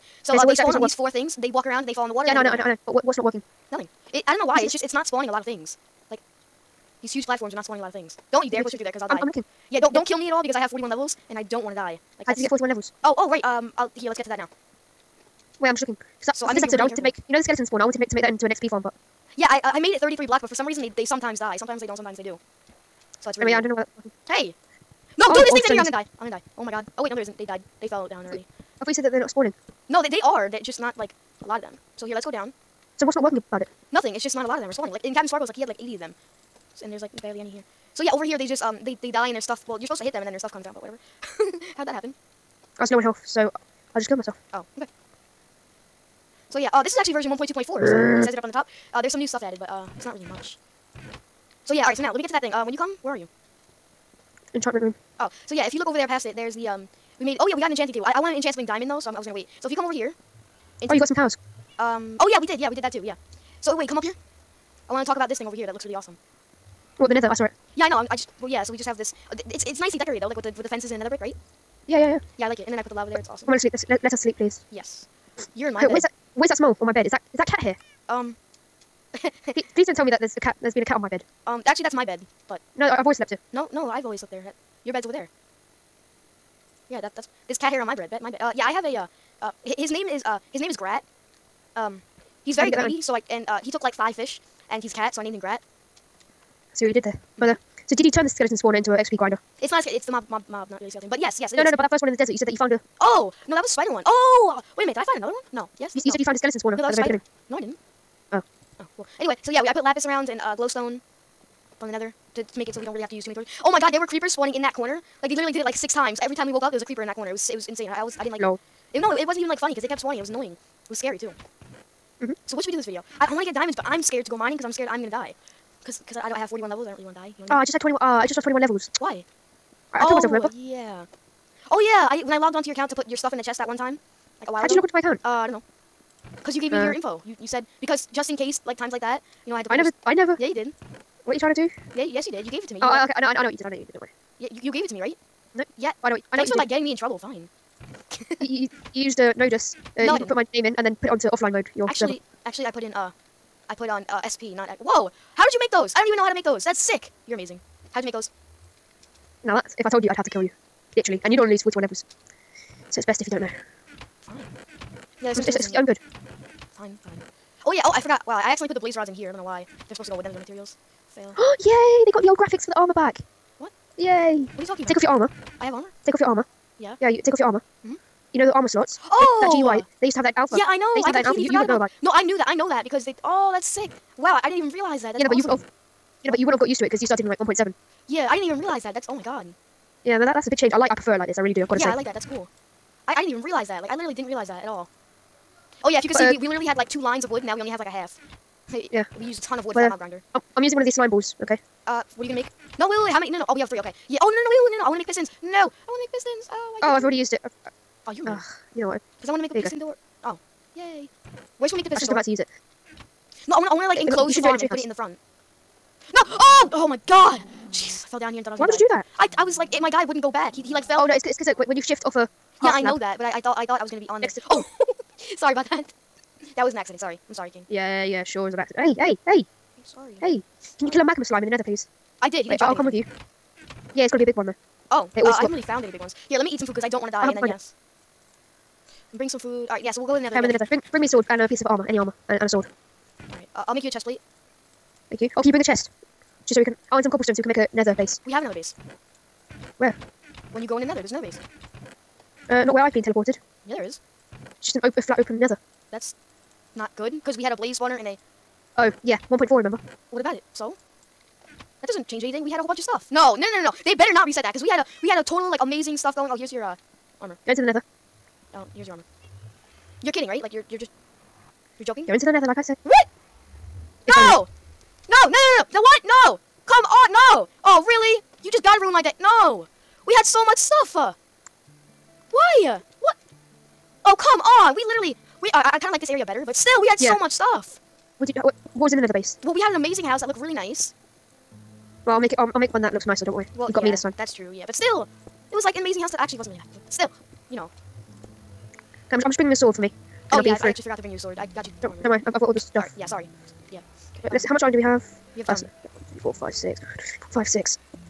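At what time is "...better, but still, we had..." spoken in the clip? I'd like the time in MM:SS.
04:46.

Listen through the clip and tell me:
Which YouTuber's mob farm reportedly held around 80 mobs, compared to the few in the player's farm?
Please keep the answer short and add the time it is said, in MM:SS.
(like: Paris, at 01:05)
CaptainSparklez, at 00:35.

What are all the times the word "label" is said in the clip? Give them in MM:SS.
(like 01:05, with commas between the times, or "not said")
not said.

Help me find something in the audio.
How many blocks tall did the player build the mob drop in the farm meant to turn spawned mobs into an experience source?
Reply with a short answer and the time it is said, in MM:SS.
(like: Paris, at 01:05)
33, at 00:19.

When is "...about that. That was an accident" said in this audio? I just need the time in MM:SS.
03:45.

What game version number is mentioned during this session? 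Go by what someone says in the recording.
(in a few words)
1.2.4.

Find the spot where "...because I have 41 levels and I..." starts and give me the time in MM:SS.
00:10.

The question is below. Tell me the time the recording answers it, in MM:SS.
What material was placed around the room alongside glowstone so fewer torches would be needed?
01:49.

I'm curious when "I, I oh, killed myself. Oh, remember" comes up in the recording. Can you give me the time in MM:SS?
02:09.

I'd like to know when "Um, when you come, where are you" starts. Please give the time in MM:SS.
00:52.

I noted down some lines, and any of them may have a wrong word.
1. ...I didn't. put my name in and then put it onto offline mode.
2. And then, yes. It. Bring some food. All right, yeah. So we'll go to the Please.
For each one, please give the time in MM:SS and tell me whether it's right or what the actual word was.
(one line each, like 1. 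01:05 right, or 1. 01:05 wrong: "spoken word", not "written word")
1. 02:30 right
2. 03:57 wrong: "Nether", not "Please".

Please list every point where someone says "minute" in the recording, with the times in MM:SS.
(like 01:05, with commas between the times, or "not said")
01:44.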